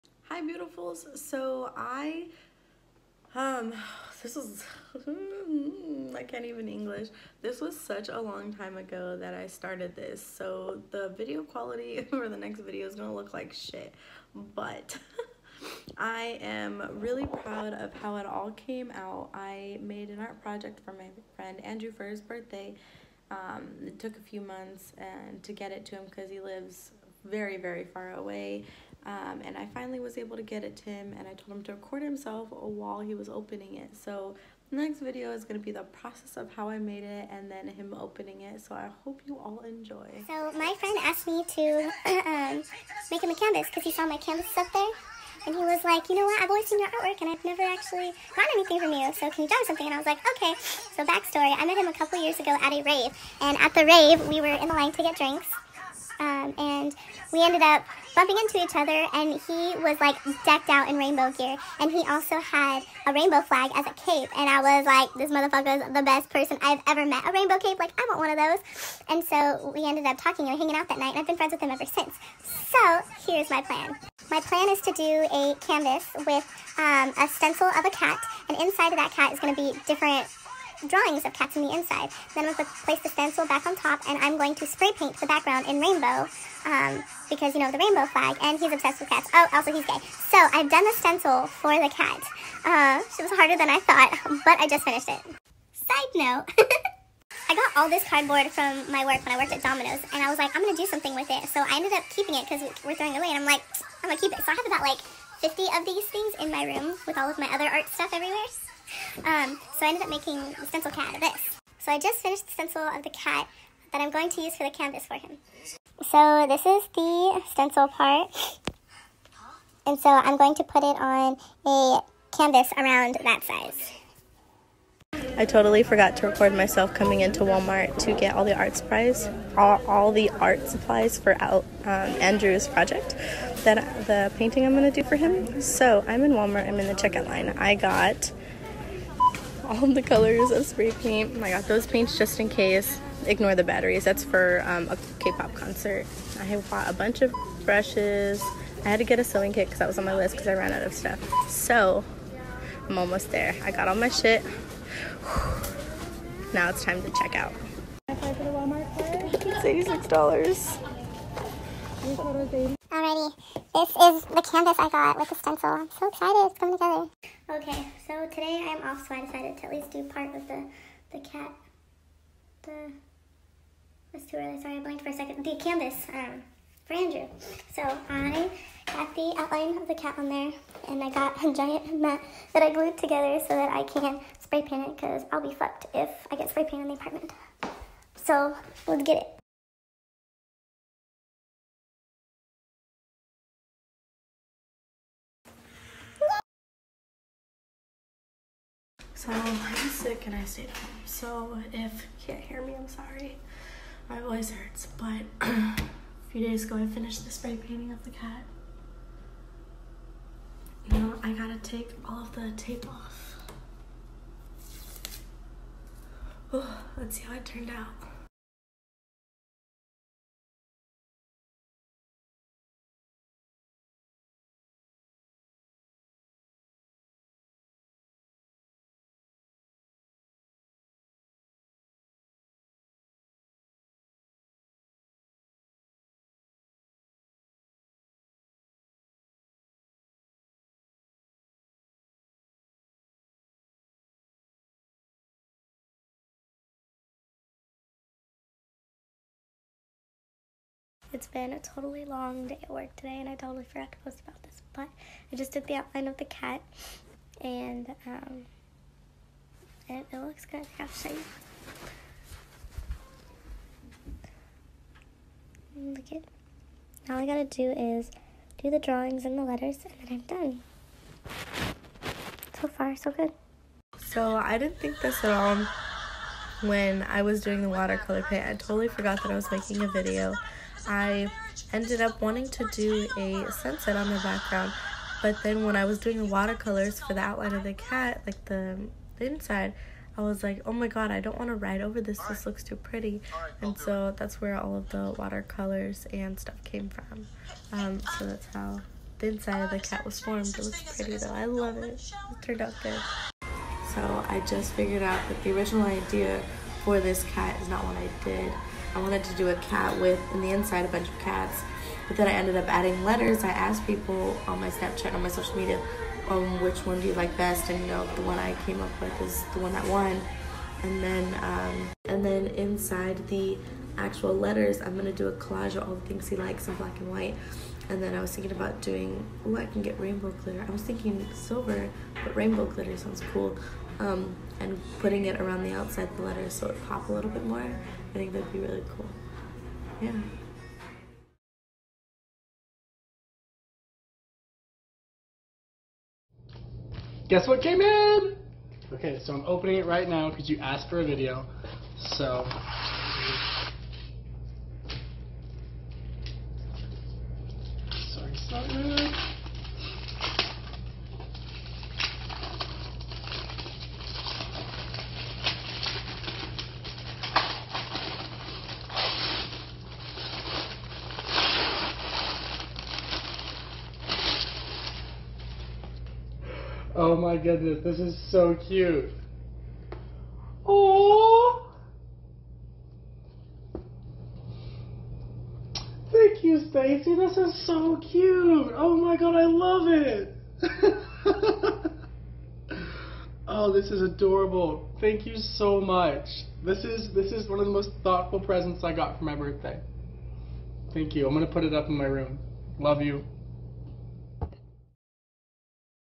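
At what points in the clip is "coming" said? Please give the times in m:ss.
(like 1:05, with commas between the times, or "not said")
2:06, 2:46.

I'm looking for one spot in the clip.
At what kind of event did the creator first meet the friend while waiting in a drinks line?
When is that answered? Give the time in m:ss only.
0:52.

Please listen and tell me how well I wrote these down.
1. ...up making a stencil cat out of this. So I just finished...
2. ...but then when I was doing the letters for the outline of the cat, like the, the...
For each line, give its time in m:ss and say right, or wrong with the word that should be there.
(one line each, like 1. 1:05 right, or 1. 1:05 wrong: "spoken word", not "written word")
1. 1:50 right
2. 4:45 wrong: "watercolors", not "letters".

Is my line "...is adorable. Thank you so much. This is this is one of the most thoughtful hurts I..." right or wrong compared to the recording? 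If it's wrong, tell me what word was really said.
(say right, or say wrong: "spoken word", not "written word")
wrong: "presents", not "hurts".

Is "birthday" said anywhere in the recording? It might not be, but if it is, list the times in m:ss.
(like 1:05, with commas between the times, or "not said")
0:22, 6:39.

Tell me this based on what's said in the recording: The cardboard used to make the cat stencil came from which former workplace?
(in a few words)
Domino's.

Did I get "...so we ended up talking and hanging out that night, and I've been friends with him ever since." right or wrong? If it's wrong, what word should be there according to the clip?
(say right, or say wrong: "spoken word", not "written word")
right.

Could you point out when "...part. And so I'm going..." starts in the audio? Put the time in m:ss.
1:57.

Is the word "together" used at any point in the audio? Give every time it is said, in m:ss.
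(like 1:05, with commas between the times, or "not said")
2:46, 3:02.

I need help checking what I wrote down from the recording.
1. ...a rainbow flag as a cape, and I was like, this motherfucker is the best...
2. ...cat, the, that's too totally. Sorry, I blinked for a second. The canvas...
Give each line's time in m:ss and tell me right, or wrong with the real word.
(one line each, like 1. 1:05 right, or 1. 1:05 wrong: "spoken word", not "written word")
1. 1:03 right
2. 2:51 wrong: "early", not "totally".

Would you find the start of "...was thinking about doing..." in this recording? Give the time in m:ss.
5:28.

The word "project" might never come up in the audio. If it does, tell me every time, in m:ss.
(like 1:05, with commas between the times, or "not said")
0:20, 2:12.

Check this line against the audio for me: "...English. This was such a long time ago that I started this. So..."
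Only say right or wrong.
right.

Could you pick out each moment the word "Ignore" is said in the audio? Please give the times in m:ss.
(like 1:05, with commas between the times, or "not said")
2:23.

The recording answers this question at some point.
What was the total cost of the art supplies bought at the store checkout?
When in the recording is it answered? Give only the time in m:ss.
2:38.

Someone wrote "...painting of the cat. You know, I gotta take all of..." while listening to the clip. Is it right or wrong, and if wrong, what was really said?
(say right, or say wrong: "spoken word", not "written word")
right.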